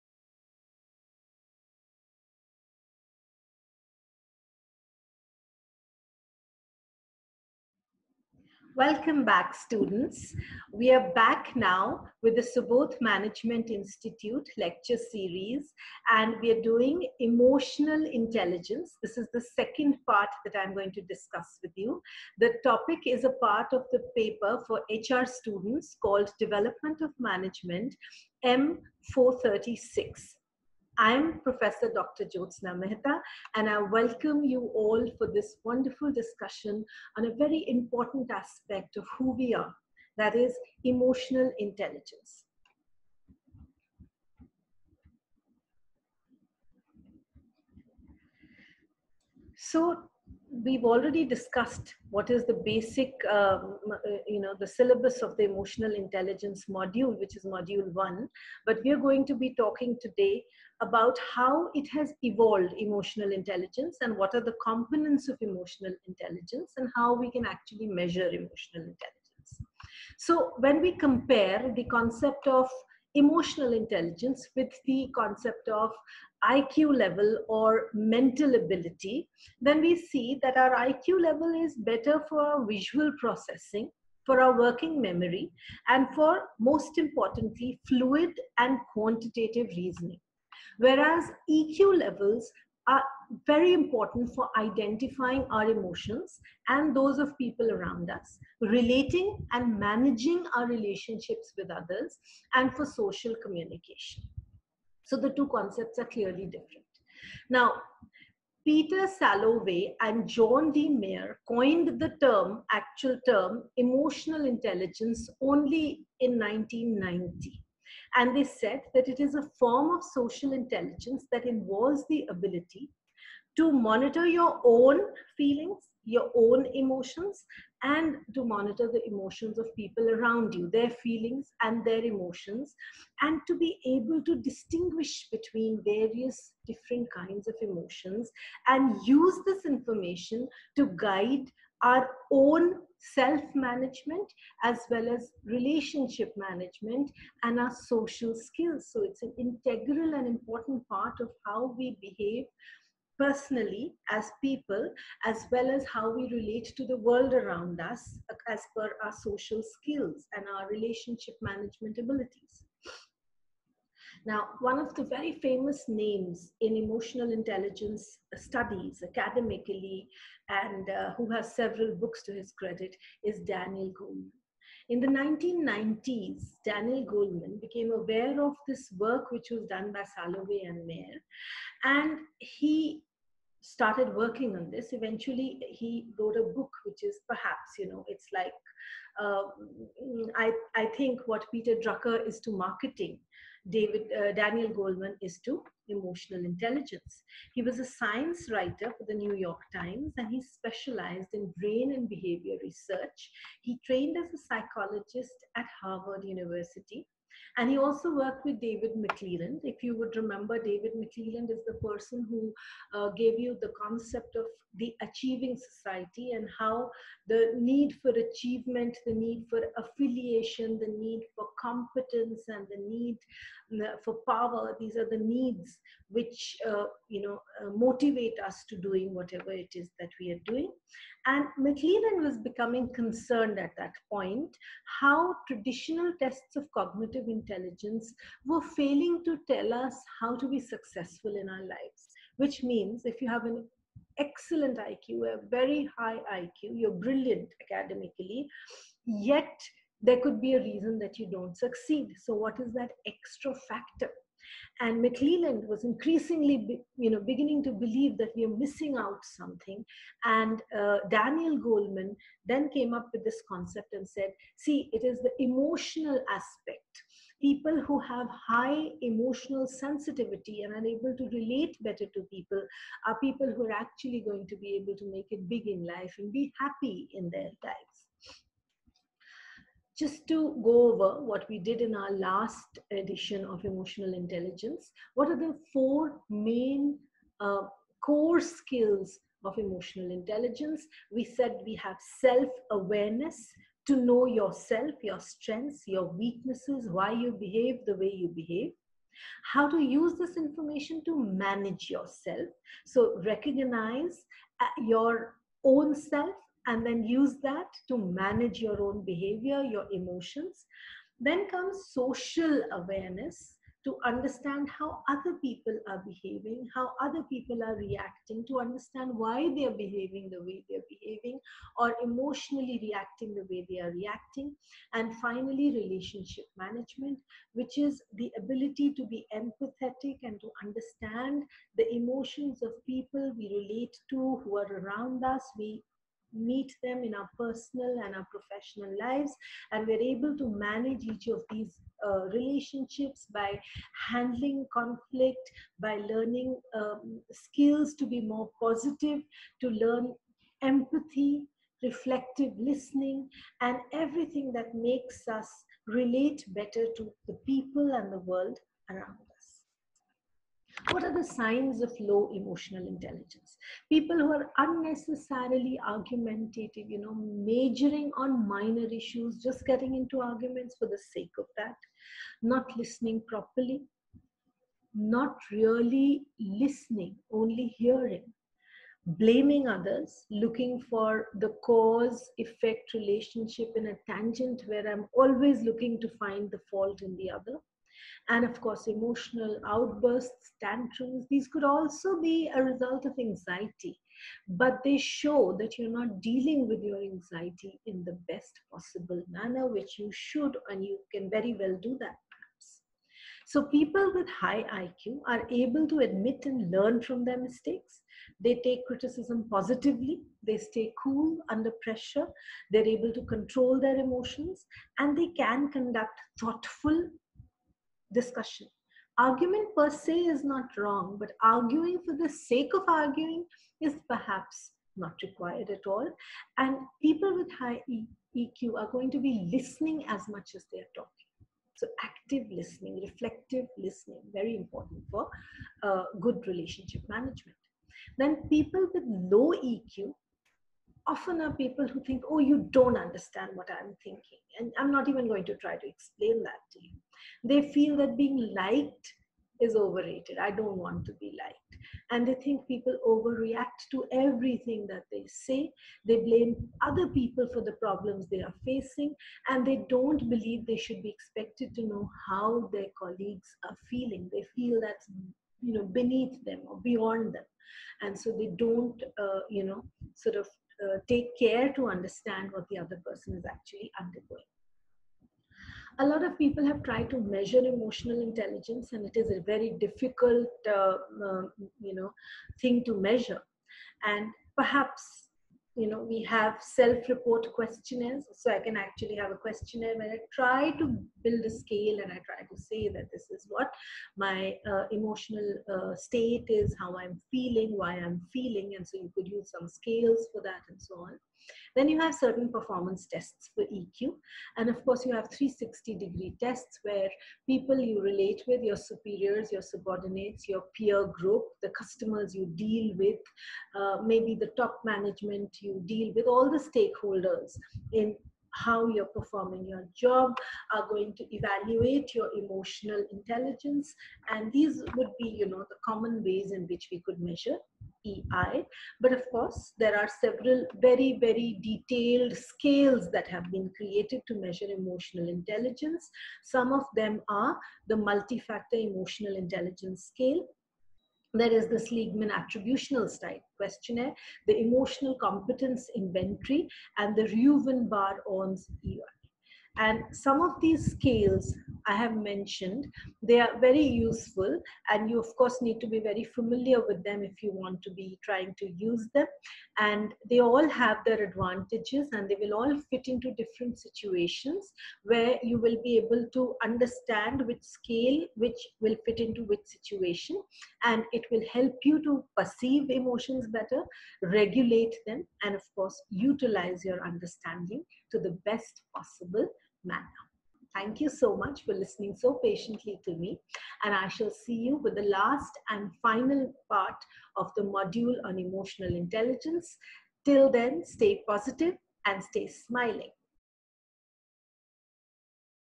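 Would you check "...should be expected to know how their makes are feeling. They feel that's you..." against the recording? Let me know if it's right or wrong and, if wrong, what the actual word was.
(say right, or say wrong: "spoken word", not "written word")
wrong: "colleagues", not "makes".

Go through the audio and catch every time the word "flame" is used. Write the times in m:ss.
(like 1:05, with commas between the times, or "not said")
not said.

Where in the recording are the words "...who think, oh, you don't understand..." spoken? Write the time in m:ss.
7:21.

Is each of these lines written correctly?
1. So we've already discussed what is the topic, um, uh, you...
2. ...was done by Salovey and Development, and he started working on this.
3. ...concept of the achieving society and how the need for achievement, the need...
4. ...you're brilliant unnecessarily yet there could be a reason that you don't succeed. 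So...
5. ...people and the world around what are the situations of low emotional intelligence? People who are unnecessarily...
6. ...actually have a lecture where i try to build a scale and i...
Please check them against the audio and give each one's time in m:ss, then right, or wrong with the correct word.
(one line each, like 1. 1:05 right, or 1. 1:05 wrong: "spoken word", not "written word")
1. 0:49 wrong: "basic", not "topic"
2. 2:59 wrong: "Mayer", not "Development"
3. 3:33 right
4. 4:06 wrong: "academically", not "unnecessarily"
5. 5:57 wrong: "signs", not "situations"
6. 8:08 wrong: "questionnaire", not "lecture".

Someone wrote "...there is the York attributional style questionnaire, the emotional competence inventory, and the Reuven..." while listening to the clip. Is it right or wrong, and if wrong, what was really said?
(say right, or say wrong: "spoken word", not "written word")
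wrong: "Seligman", not "York".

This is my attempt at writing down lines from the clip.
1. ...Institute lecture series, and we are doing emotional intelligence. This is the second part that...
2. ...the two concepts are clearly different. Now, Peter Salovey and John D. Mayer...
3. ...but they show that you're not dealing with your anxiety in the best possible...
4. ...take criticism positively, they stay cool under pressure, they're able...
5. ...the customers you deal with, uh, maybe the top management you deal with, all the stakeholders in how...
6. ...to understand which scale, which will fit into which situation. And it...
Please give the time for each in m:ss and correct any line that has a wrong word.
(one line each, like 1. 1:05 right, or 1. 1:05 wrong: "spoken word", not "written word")
1. 0:13 right
2. 1:45 right
3. 6:34 right
4. 6:48 right
5. 8:31 right
6. 9:26 right.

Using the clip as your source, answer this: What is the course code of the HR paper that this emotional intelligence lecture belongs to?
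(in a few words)
M436.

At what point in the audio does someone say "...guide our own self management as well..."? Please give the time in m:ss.
2:20.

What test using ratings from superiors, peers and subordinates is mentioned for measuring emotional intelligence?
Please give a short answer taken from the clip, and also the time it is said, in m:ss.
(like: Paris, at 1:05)
360 degree tests, at 8:25.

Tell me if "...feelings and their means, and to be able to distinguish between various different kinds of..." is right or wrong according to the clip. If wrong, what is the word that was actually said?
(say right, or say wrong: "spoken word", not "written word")
wrong: "emotions", not "means".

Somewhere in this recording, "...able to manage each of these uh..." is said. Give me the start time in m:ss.
5:40.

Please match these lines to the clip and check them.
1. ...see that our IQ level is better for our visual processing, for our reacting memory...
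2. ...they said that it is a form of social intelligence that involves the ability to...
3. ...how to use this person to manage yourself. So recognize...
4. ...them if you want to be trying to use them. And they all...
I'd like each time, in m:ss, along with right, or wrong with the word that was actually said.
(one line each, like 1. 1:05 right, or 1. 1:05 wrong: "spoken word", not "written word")
1. 1:19 wrong: "working", not "reacting"
2. 1:58 right
3. 4:59 wrong: "information", not "person"
4. 9:17 right.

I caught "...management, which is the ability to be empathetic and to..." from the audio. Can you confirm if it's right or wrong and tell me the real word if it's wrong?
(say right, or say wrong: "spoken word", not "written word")
right.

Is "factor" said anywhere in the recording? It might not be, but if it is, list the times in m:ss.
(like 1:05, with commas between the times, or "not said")
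4:13, 8:58.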